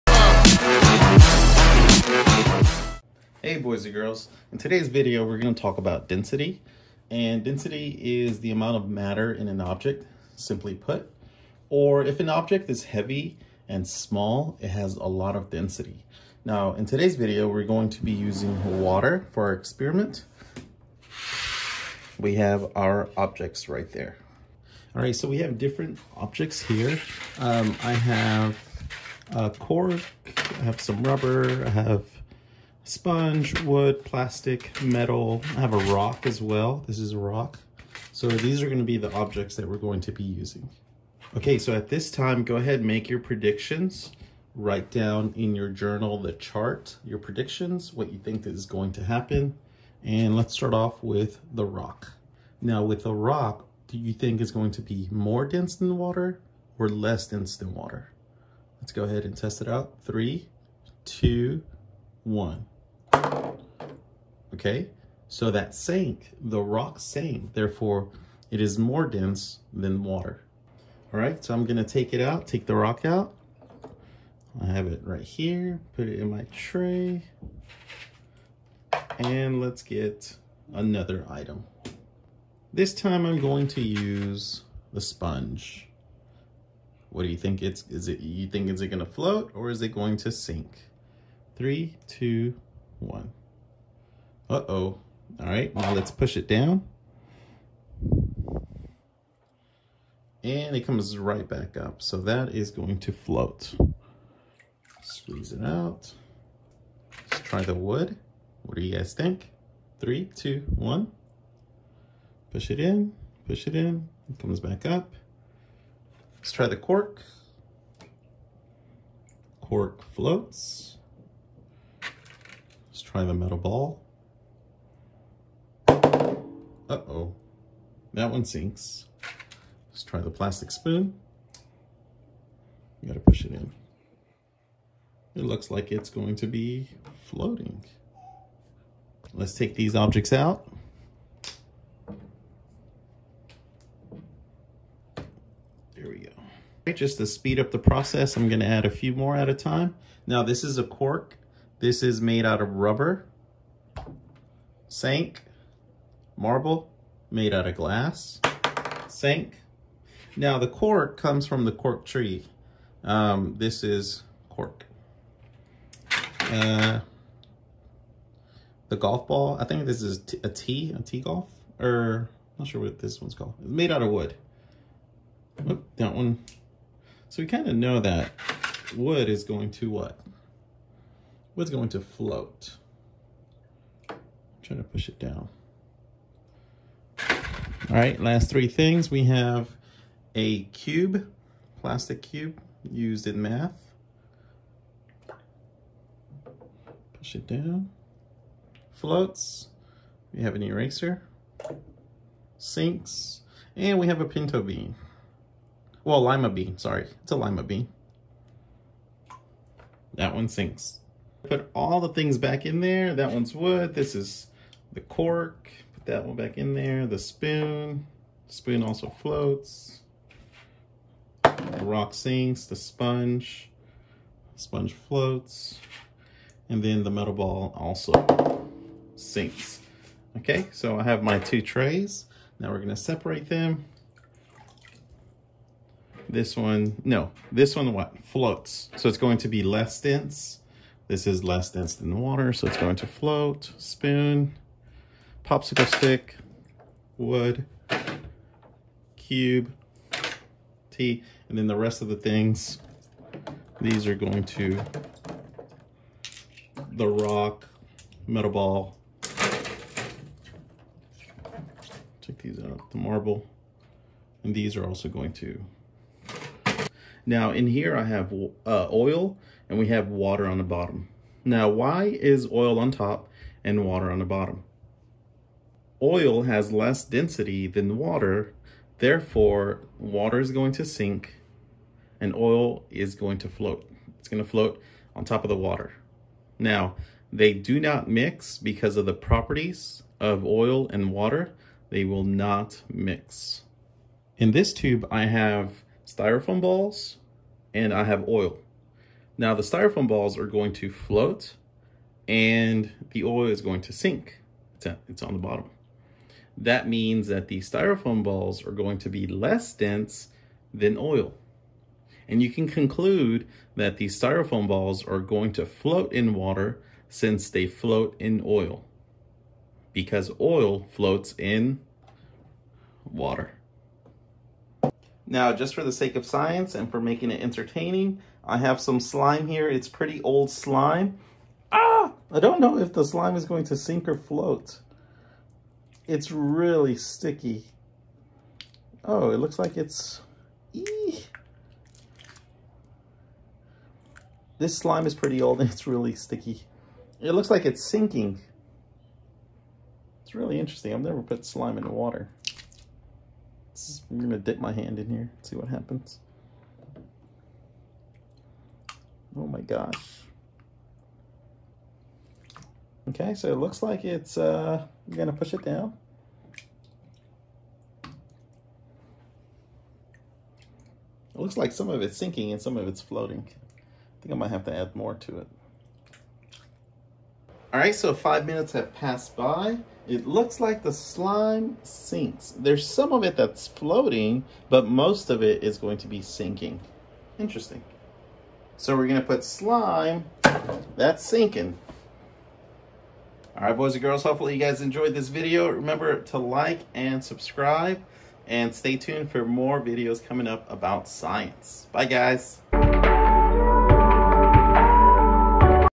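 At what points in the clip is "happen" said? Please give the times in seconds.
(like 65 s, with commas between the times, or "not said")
49 s, 355 s.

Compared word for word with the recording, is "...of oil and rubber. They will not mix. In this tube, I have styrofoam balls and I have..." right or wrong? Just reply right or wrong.
wrong.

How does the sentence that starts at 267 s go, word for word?
Now in here I have uh, oil and we have water on the bottom.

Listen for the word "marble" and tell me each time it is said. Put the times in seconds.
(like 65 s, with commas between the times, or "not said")
156 s, 262 s.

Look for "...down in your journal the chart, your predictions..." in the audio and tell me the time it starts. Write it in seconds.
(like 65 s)
44 s.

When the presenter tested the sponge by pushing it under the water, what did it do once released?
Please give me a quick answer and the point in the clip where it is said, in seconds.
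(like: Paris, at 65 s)
comes right back up, at 100 s.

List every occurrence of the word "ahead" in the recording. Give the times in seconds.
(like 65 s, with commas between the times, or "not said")
42 s, 59 s.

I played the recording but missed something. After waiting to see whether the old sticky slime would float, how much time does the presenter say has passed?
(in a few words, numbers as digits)
5 minutes.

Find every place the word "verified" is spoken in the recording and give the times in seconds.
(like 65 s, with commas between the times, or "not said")
not said.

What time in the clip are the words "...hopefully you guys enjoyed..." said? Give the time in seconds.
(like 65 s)
394 s.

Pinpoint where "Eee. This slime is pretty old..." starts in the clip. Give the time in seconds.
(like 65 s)
340 s.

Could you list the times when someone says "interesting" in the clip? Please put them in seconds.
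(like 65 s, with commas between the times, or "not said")
350 s, 387 s.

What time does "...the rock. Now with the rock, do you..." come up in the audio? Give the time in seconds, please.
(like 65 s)
51 s.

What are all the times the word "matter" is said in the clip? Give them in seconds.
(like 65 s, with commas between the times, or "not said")
8 s.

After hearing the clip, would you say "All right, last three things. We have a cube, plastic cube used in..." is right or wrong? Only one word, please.
right.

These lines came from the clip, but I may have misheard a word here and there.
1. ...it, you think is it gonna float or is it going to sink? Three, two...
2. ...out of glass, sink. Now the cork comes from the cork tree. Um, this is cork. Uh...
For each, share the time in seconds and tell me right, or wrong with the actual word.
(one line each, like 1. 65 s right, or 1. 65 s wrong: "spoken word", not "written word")
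1. 88 s right
2. 157 s right.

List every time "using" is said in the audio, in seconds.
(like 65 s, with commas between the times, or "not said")
18 s, 40 s.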